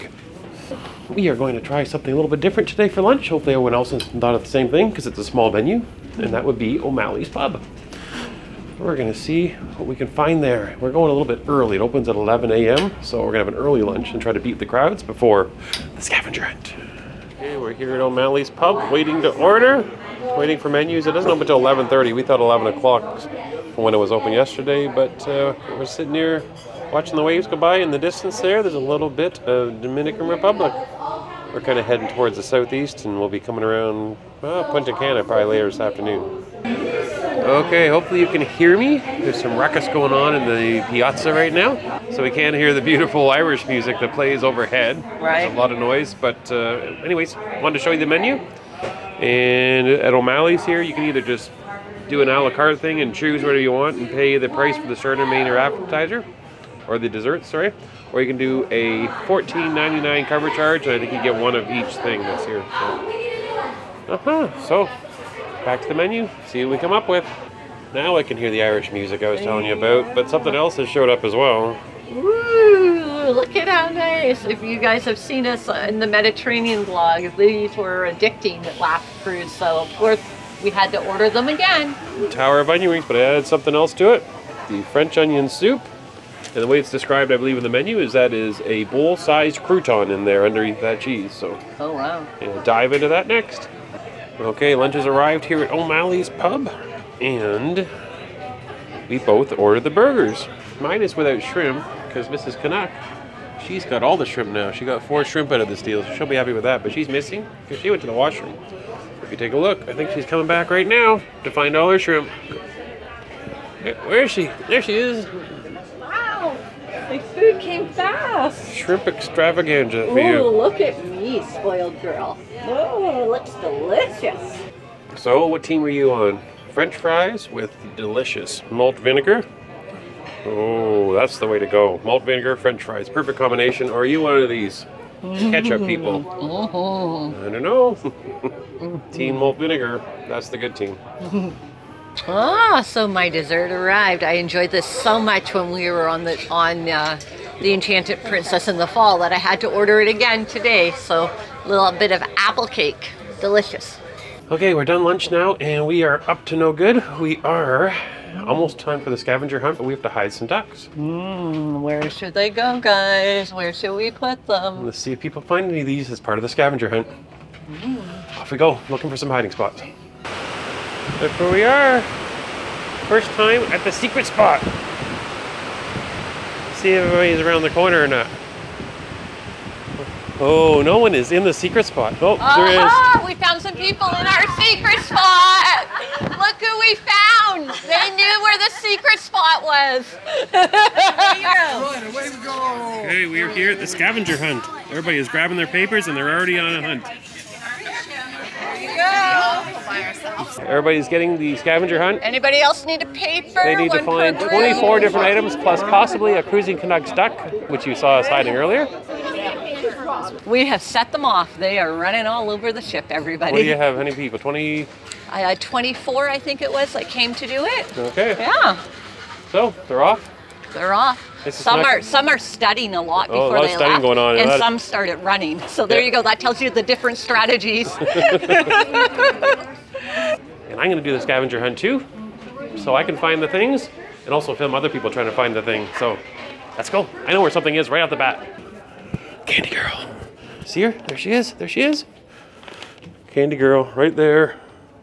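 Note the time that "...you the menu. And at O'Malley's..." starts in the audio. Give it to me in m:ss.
0:47.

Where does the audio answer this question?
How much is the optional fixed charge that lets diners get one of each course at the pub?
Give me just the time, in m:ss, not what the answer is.
0:59.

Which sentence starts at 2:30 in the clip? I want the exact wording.
So a little bit of apple cake, delicious.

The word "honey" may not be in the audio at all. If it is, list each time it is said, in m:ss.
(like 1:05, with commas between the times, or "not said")
not said.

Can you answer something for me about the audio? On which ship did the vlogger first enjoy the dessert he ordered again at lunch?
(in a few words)
Enchanted Princess.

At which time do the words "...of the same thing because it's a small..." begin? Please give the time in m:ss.
0:04.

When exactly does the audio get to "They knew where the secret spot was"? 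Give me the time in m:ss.
3:07.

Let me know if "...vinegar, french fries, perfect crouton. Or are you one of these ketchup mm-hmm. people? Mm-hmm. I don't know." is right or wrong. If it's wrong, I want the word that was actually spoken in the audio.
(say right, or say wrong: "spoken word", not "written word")
wrong: "combination", not "crouton".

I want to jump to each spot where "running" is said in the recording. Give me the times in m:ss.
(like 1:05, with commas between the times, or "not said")
3:31, 3:45.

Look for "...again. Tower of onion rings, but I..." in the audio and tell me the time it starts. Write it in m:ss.
1:21.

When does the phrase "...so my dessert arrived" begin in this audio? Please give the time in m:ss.
2:22.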